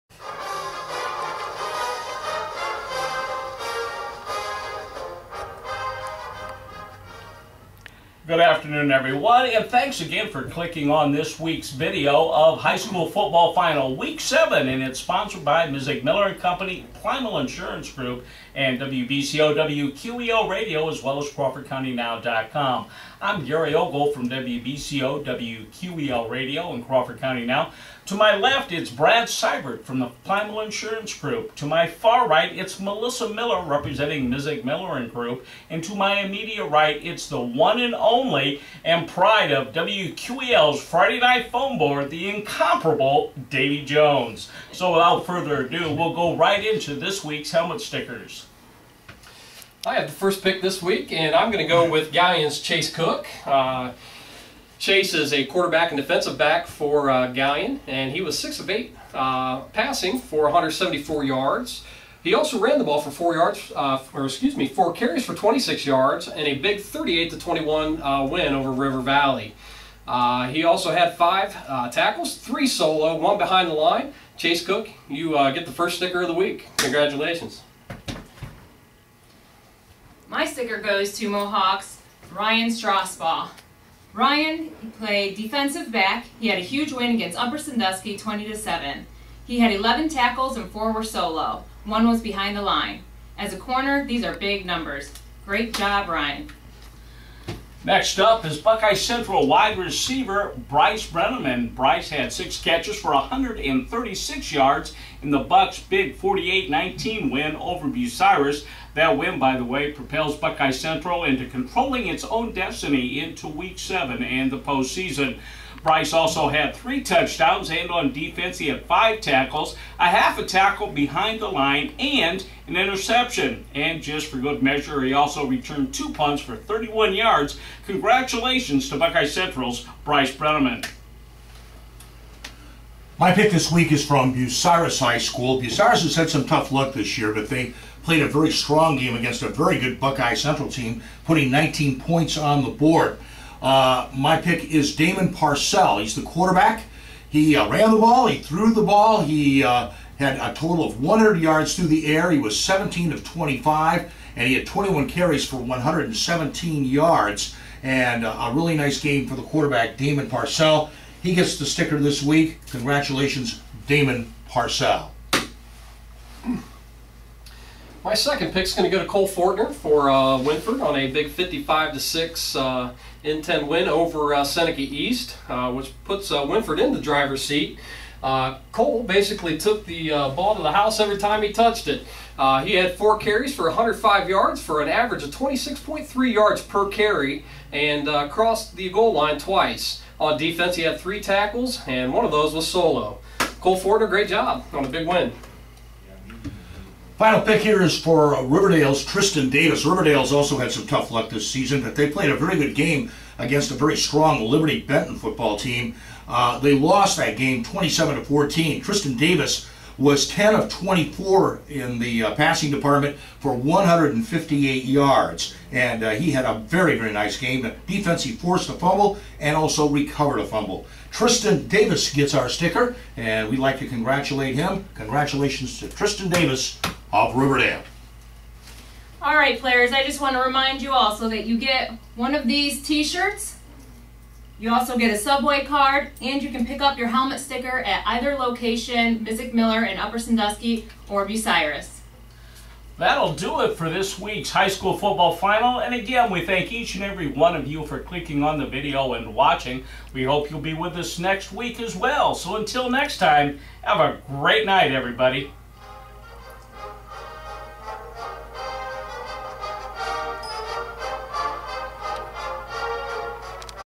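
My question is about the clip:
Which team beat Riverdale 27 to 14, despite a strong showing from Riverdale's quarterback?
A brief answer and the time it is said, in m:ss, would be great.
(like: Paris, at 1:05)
Liberty Benton, at 3:24.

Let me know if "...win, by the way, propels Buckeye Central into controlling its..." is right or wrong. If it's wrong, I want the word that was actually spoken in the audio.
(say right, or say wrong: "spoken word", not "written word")
right.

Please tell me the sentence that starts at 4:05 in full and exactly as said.
And again, we thank each and every one of you for clicking on the video and watching.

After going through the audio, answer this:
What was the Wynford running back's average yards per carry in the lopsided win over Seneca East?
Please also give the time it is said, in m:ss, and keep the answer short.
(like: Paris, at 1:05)
26.3, at 3:05.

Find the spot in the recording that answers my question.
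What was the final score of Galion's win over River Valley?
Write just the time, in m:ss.
1:06.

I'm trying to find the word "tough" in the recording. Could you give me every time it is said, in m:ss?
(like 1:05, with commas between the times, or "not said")
2:16, 3:20.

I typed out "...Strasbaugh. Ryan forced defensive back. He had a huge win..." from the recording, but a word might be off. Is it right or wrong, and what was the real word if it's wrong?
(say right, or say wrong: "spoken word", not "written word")
wrong: "played", not "forced".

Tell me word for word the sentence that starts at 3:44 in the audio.
Congratulations to Tristan Davis of Riverdale.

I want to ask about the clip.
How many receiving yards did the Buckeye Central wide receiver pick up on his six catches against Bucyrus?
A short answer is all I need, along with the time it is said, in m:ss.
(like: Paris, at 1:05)
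136, at 1:43.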